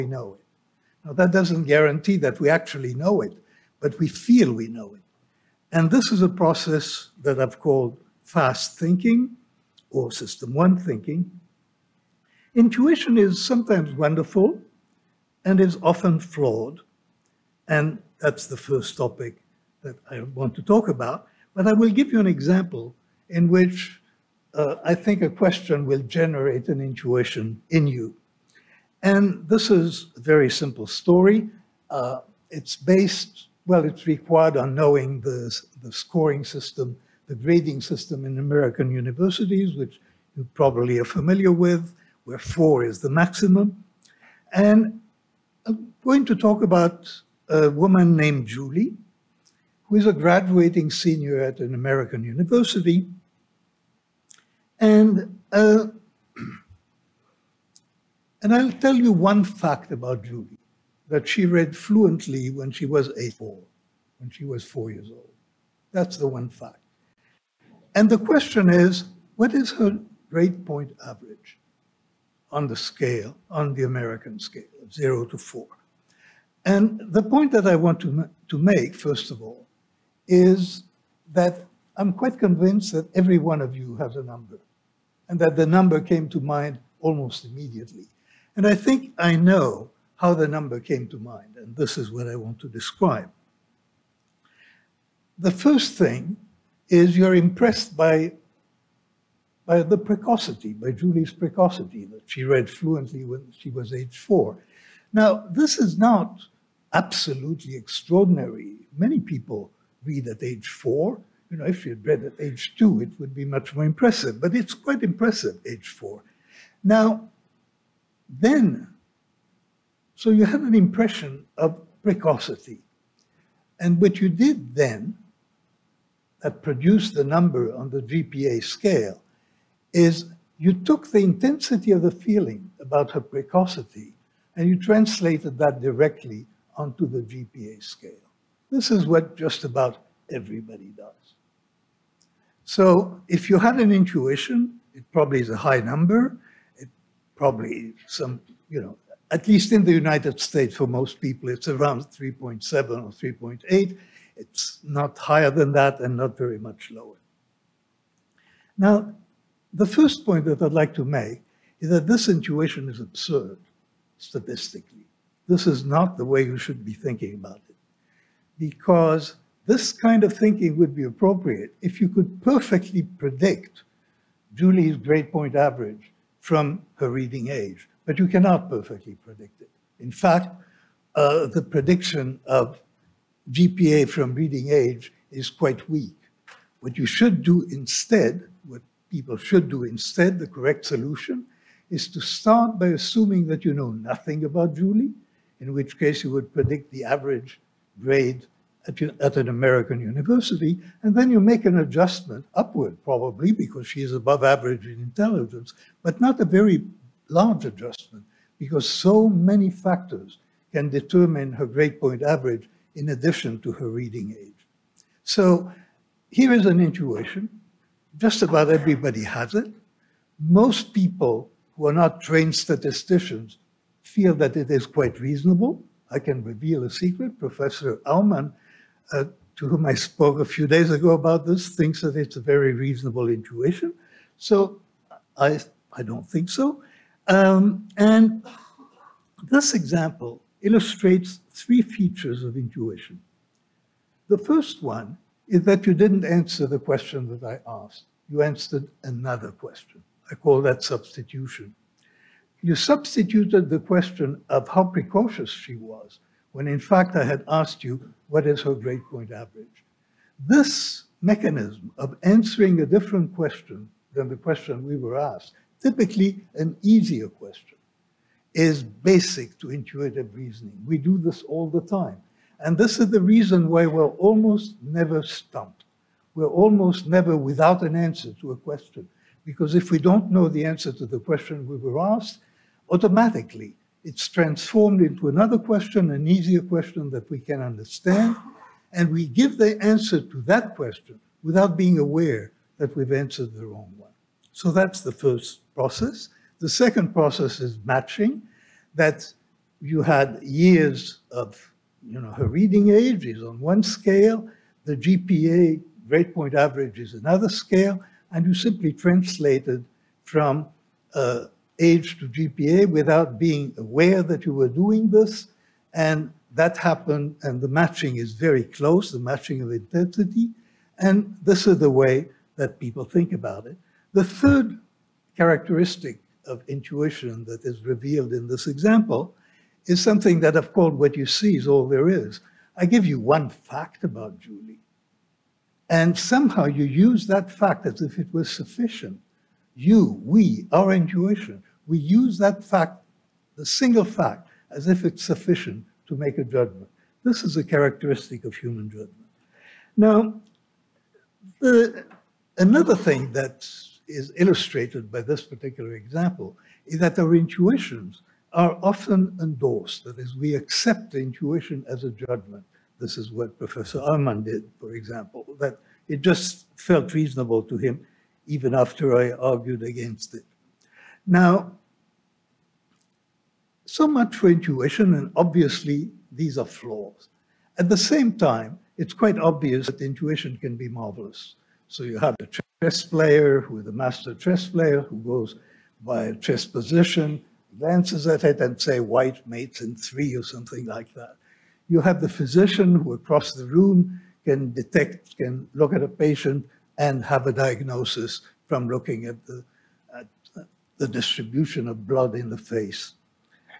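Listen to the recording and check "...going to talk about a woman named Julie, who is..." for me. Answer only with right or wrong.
right.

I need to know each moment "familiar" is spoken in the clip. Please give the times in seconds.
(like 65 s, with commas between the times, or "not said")
41 s.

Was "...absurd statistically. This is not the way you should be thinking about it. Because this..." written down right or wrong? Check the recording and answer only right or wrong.
right.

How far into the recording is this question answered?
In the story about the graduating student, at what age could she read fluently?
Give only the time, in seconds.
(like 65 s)
64 s.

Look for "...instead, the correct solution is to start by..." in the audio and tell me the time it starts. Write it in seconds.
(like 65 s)
189 s.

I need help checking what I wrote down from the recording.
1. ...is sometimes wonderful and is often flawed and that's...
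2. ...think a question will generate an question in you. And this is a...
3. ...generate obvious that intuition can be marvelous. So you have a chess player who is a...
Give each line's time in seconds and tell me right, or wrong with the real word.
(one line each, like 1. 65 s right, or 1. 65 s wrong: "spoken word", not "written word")
1. 13 s right
2. 24 s wrong: "intuition", not "question"
3. 379 s wrong: "quite", not "generate".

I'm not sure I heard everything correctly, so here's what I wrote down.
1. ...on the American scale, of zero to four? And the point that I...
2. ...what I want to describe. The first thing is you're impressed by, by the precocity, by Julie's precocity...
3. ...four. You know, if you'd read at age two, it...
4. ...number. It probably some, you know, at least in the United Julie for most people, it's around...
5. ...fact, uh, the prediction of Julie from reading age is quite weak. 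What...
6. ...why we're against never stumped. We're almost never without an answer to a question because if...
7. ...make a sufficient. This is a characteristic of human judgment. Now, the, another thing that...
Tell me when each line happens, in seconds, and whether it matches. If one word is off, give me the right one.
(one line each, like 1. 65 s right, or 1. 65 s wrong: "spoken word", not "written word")
1. 73 s right
2. 92 s right
3. 110 s right
4. 145 s wrong: "States", not "Julie"
5. 180 s wrong: "GPA", not "Julie"
6. 273 s wrong: "almost", not "against"
7. 346 s wrong: "judgment", not "sufficient".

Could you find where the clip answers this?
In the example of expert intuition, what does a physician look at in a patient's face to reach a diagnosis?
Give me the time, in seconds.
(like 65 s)
401 s.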